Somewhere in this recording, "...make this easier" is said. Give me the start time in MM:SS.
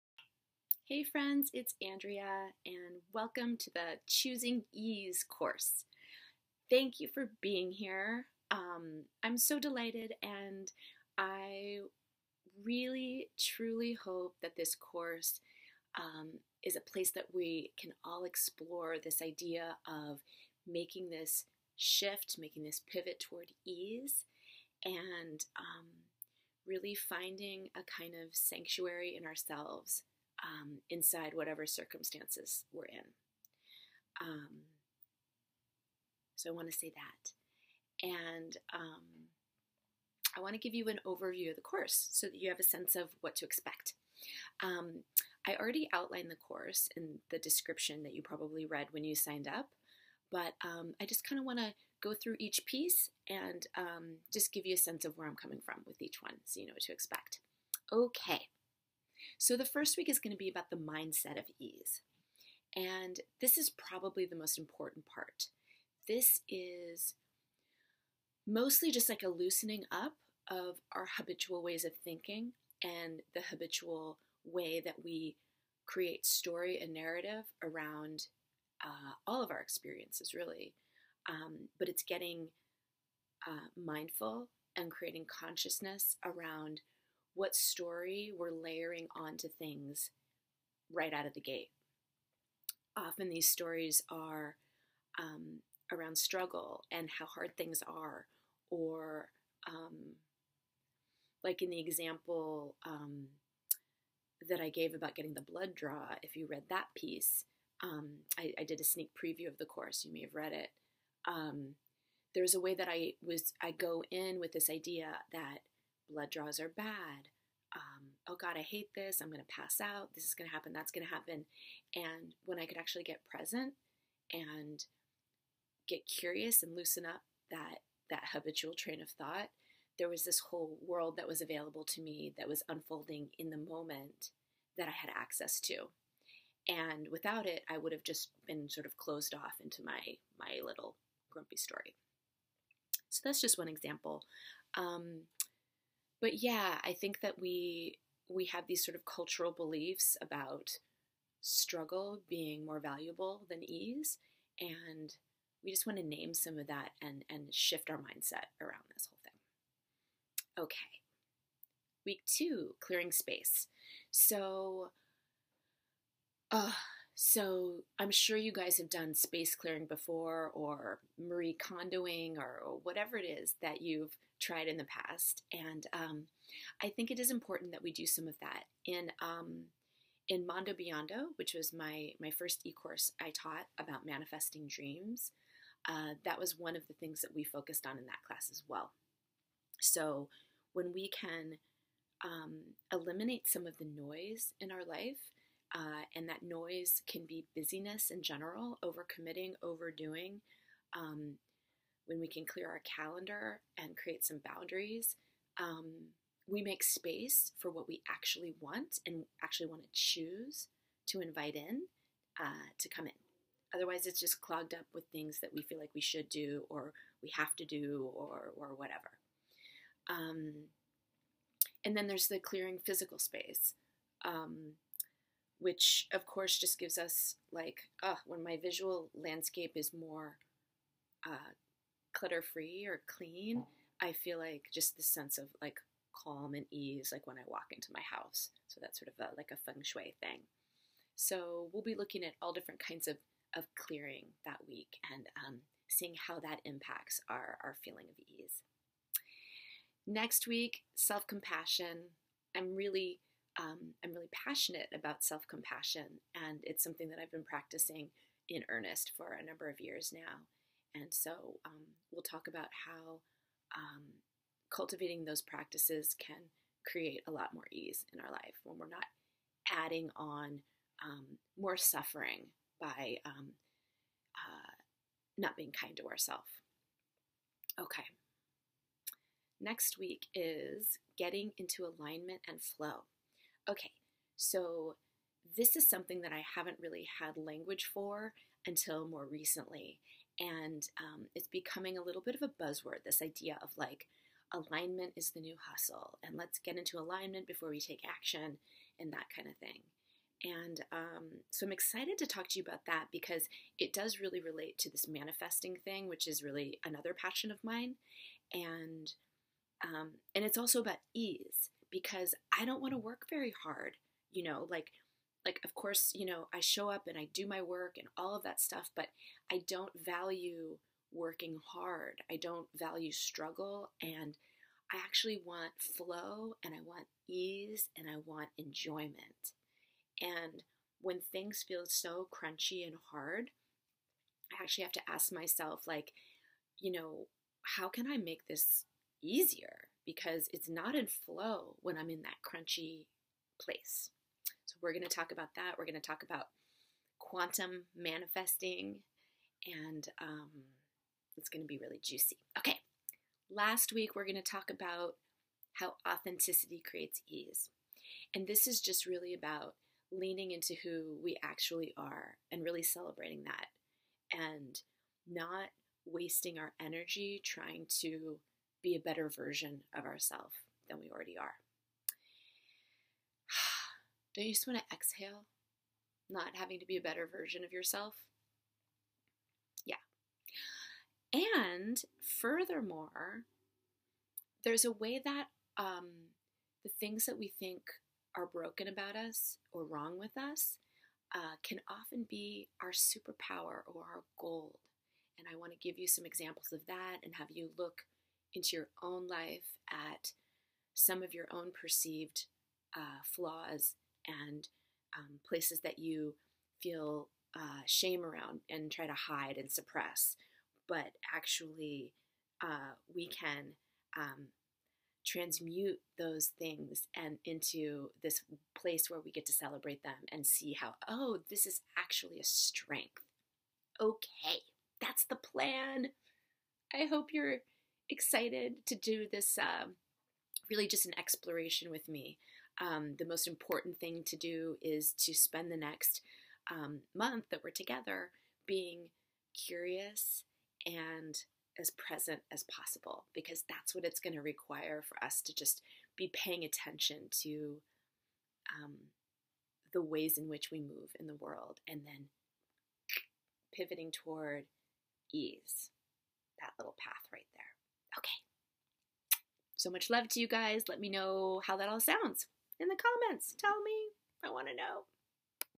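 05:38.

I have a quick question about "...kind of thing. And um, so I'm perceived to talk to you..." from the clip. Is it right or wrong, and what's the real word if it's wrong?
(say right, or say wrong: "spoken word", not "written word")
wrong: "excited", not "perceived".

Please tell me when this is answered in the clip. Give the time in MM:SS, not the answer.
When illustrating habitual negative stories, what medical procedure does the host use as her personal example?
01:45.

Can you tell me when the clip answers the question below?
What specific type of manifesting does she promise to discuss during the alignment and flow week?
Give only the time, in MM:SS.
05:47.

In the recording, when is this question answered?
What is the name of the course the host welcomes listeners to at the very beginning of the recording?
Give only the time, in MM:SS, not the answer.
00:04.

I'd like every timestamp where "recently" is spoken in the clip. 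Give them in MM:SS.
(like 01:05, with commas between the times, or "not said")
04:49.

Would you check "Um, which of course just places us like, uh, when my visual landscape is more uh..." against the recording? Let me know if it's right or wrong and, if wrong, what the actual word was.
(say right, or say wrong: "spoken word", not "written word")
wrong: "gives", not "places".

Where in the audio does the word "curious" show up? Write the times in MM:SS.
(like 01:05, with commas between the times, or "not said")
02:06, 07:19.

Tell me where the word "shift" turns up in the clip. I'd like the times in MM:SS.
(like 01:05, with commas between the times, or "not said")
00:21, 02:37.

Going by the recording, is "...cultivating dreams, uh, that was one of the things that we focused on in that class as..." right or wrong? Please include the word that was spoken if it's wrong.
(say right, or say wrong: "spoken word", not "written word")
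wrong: "manifesting", not "cultivating".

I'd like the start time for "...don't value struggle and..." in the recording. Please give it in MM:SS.
05:22.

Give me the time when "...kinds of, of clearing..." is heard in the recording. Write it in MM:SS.
04:02.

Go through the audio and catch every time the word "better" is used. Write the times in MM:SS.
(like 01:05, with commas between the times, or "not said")
06:08, 06:17.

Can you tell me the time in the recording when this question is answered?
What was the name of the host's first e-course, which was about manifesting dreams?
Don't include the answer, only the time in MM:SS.
03:00.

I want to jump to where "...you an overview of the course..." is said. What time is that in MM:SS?
00:40.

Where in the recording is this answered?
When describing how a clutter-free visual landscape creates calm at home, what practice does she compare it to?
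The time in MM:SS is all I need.
03:59.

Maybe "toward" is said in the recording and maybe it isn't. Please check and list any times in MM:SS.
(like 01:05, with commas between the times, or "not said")
00:23, 07:34.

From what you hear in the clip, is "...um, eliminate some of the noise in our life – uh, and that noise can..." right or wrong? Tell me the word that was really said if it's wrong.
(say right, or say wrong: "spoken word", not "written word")
right.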